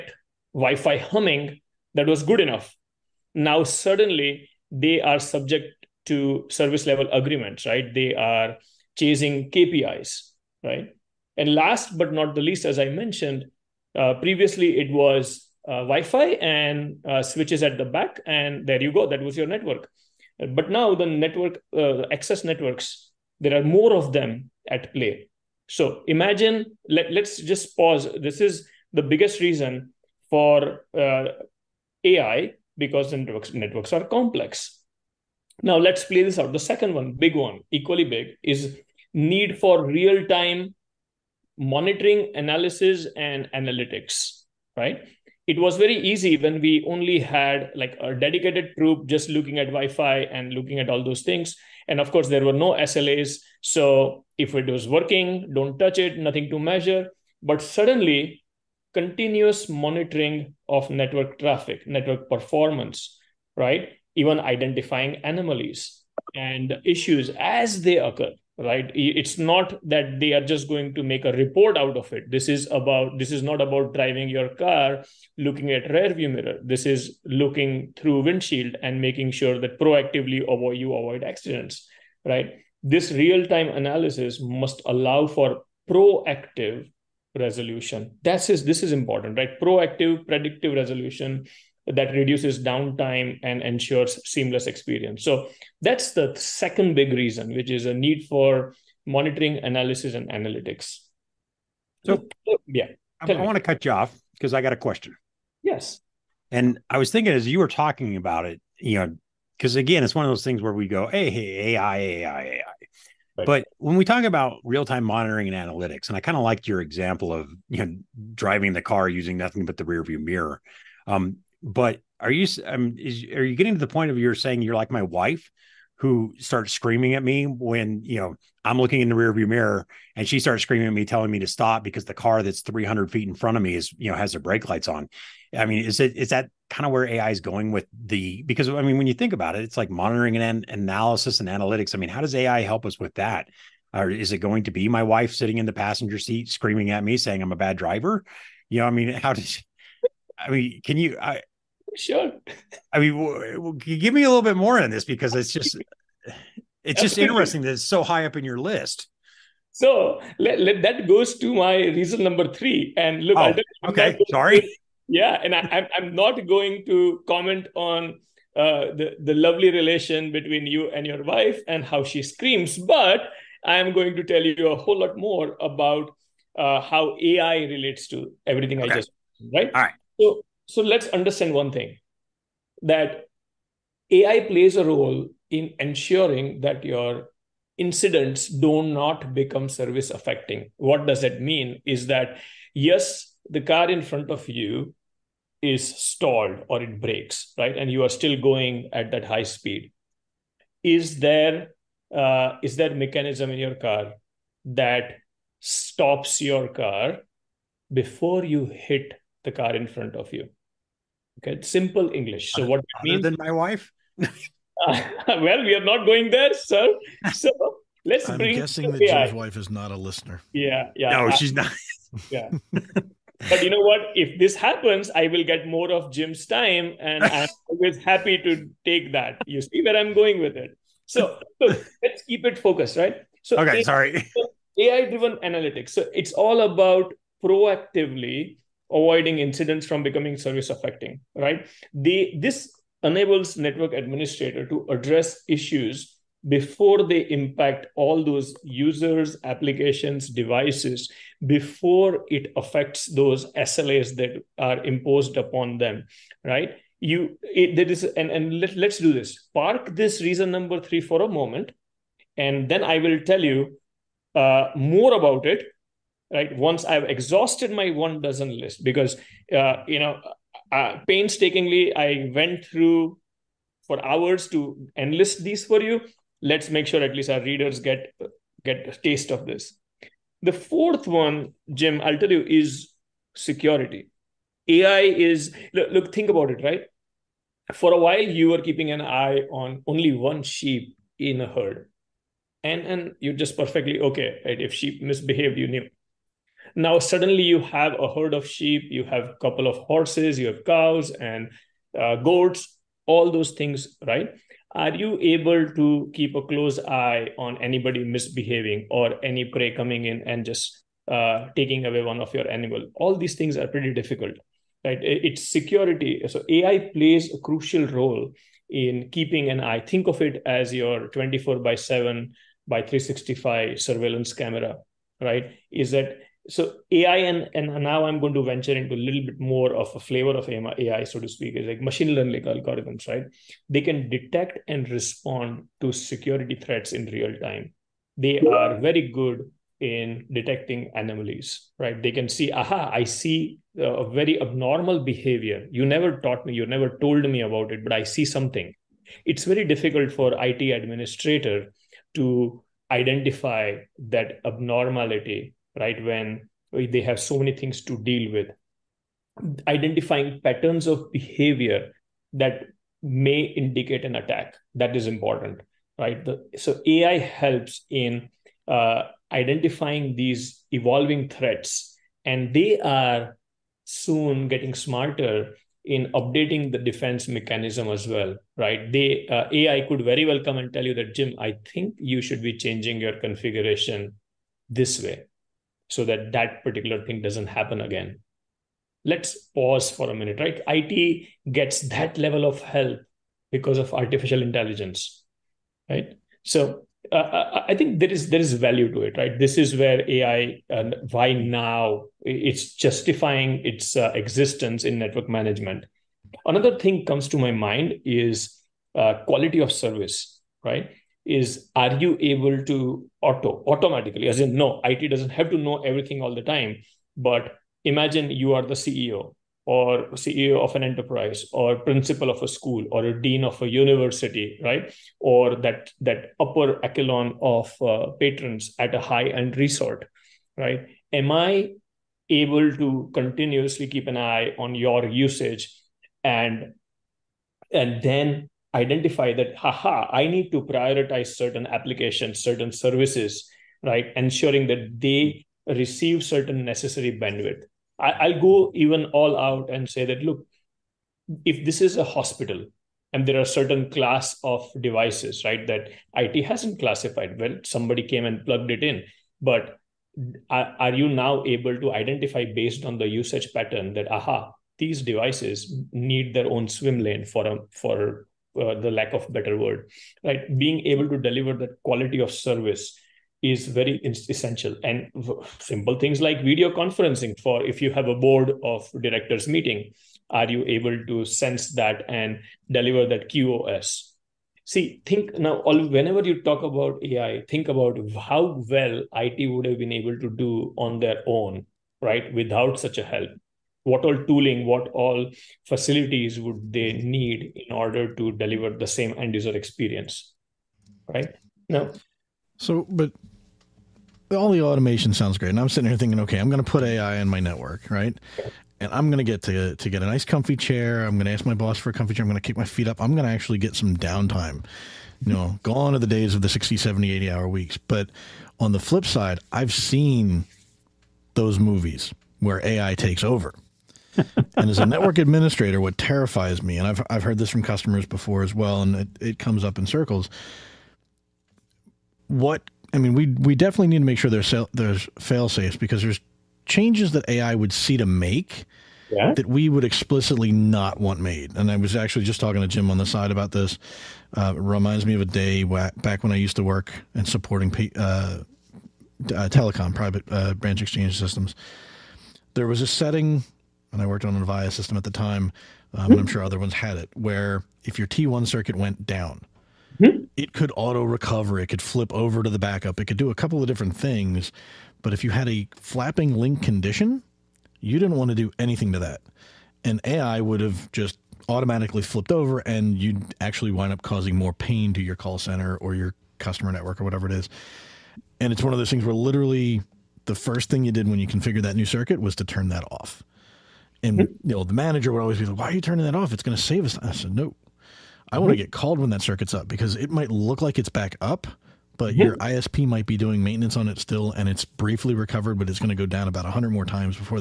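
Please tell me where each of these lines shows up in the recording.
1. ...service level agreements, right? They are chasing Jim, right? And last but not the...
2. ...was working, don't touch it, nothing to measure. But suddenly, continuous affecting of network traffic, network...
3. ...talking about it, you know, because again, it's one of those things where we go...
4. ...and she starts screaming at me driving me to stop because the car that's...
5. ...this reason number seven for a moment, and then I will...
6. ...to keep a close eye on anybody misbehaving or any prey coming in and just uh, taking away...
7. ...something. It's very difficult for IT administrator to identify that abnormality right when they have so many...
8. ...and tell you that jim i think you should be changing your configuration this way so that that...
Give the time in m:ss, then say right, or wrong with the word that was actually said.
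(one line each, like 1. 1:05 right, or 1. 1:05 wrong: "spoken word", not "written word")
1. 0:06 wrong: "KPIs", not "Jim"
2. 0:54 wrong: "monitoring", not "affecting"
3. 1:47 right
4. 2:10 wrong: "telling", not "driving"
5. 4:19 wrong: "three", not "seven"
6. 5:05 right
7. 5:48 right
8. 6:20 right.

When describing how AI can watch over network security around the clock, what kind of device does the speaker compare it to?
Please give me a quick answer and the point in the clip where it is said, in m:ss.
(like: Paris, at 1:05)
surveillance camera, at 5:23.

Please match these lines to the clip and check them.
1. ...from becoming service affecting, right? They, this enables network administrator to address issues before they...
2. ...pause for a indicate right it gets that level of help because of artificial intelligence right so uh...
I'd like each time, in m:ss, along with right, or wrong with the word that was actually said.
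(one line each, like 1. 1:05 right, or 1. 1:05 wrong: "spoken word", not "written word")
1. 3:59 right
2. 6:29 wrong: "minute", not "indicate".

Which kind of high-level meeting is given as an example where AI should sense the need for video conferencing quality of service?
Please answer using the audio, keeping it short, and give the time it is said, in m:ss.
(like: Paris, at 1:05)
board of directors meeting, at 7:58.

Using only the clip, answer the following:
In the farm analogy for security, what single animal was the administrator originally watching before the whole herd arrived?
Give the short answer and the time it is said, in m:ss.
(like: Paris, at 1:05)
one sheep, at 4:50.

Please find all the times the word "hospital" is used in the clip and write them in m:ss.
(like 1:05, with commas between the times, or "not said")
7:32.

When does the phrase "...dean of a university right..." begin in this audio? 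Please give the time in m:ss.
7:03.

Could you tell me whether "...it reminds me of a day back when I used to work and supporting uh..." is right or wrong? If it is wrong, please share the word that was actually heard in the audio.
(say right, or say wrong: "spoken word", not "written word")
right.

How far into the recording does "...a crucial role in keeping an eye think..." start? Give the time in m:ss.
5:17.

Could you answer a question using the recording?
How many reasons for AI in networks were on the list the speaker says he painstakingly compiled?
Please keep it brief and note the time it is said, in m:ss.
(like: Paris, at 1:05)
one dozen, at 4:28.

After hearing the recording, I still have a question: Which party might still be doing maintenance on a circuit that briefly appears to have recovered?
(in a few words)
ISP.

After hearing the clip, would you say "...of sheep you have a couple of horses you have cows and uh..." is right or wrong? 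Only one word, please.
right.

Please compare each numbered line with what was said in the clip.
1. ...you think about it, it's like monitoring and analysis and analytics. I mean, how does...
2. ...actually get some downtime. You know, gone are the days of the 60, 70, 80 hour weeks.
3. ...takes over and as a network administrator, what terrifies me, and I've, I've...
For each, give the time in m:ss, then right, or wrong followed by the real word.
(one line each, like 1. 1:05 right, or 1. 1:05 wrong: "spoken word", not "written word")
1. 2:19 right
2. 8:33 right
3. 8:42 right.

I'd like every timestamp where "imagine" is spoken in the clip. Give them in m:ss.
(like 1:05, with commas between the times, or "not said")
0:26, 6:57.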